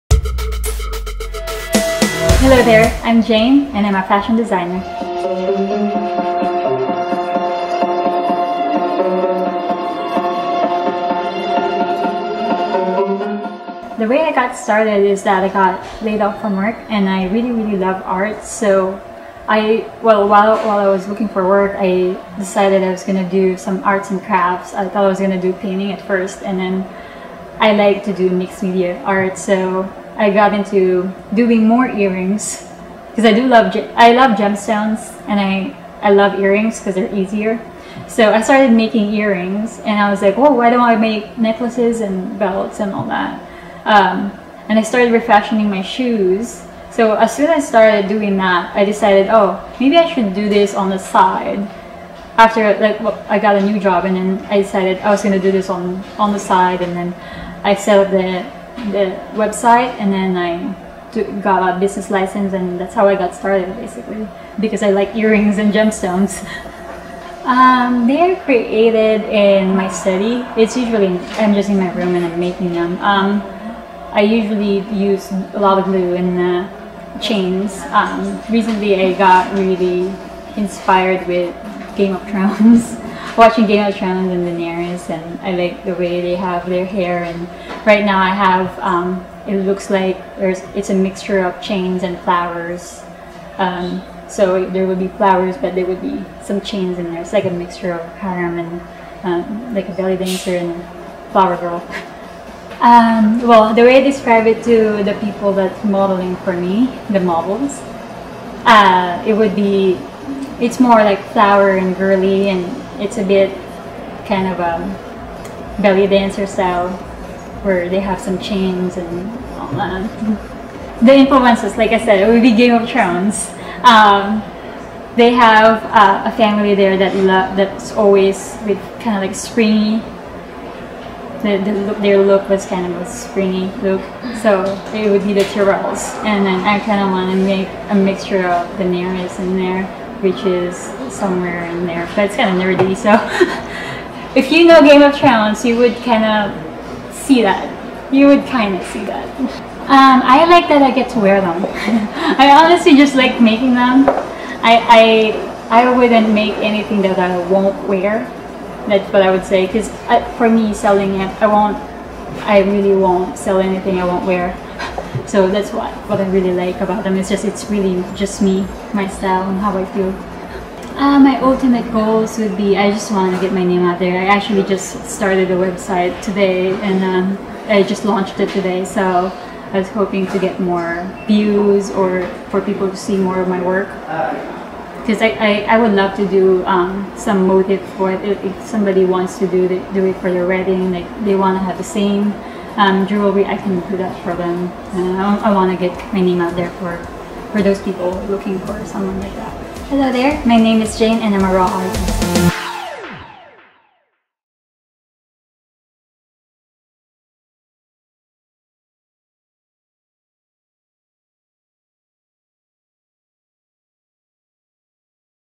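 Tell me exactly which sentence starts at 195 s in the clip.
I, I want to get my name out there for, for those people looking for someone like that.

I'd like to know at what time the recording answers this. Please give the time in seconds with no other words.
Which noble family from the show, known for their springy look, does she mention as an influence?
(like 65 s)
135 s.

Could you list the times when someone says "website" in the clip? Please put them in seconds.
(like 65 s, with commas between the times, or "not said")
59 s, 175 s.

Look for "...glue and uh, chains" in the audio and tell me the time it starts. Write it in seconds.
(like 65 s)
75 s.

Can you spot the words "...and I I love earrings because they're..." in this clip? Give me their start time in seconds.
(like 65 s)
35 s.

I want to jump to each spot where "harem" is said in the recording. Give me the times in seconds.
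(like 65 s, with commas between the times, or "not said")
98 s.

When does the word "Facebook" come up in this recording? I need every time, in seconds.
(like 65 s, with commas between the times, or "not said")
not said.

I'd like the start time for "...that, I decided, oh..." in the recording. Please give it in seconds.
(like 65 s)
48 s.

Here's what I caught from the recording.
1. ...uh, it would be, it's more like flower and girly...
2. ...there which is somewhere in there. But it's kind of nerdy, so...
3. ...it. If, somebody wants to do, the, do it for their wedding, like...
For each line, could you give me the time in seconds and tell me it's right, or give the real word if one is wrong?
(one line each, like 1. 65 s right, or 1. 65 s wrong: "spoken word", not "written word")
1. 108 s right
2. 139 s right
3. 188 s right.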